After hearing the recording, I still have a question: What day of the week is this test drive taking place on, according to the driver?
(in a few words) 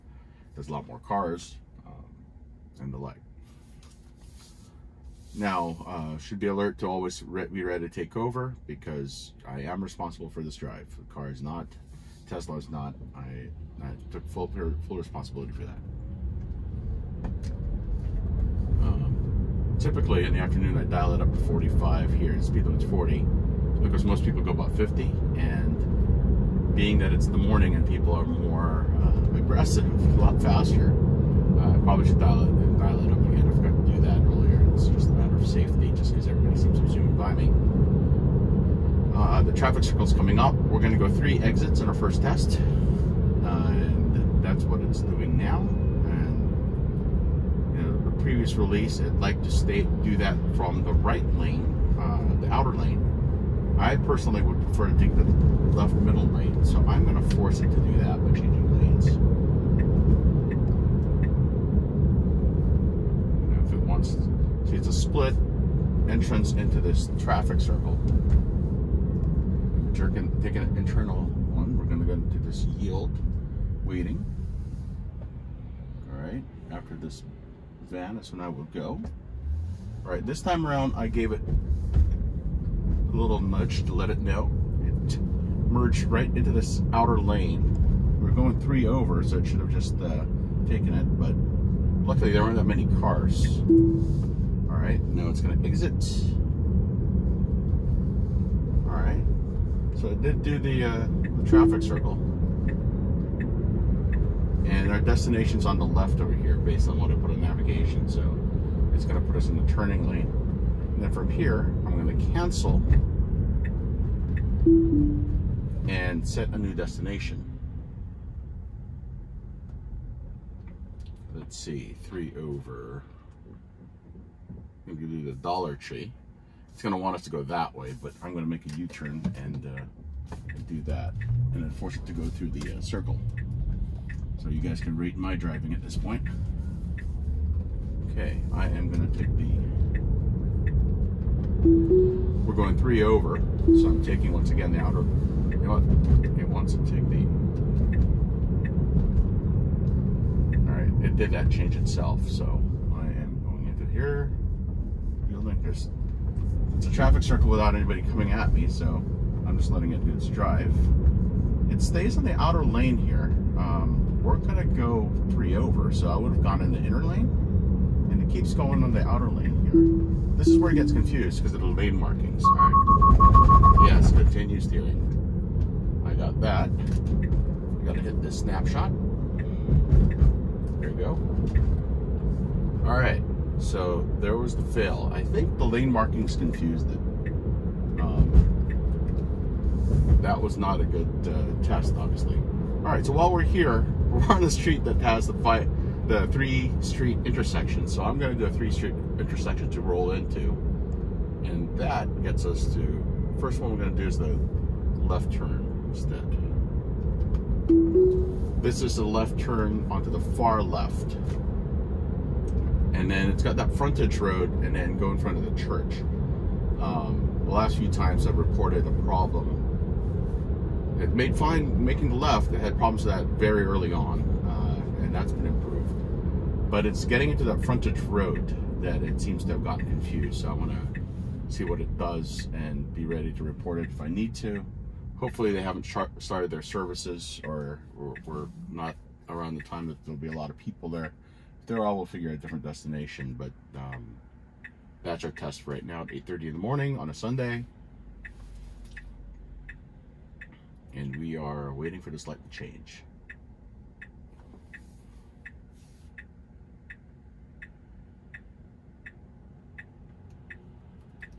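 Sunday.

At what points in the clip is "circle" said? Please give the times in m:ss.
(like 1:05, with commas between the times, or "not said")
0:39, 1:07, 1:41, 2:12, 2:37.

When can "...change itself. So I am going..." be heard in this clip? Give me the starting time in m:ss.
2:31.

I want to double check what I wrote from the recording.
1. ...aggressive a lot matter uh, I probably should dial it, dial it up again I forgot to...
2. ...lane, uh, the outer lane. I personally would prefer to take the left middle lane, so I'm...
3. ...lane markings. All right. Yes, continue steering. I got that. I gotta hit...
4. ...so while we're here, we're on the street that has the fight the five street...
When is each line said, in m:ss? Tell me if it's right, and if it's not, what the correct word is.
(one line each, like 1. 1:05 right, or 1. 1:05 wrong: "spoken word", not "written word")
1. 0:29 wrong: "faster", not "matter"
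2. 0:51 right
3. 2:51 right
4. 3:13 wrong: "three", not "five".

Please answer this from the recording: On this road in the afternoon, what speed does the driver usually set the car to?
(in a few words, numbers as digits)
45.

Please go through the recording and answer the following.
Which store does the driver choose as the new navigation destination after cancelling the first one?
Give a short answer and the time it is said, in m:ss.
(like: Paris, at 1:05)
Dollar Tree, at 2:05.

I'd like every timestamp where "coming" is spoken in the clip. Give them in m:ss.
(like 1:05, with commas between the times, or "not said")
0:40, 2:38.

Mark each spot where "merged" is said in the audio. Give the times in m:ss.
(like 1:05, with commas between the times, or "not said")
1:25.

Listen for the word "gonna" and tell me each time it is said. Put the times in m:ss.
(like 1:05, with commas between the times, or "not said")
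1:35, 2:18, 2:44.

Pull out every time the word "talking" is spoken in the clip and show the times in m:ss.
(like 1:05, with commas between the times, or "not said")
not said.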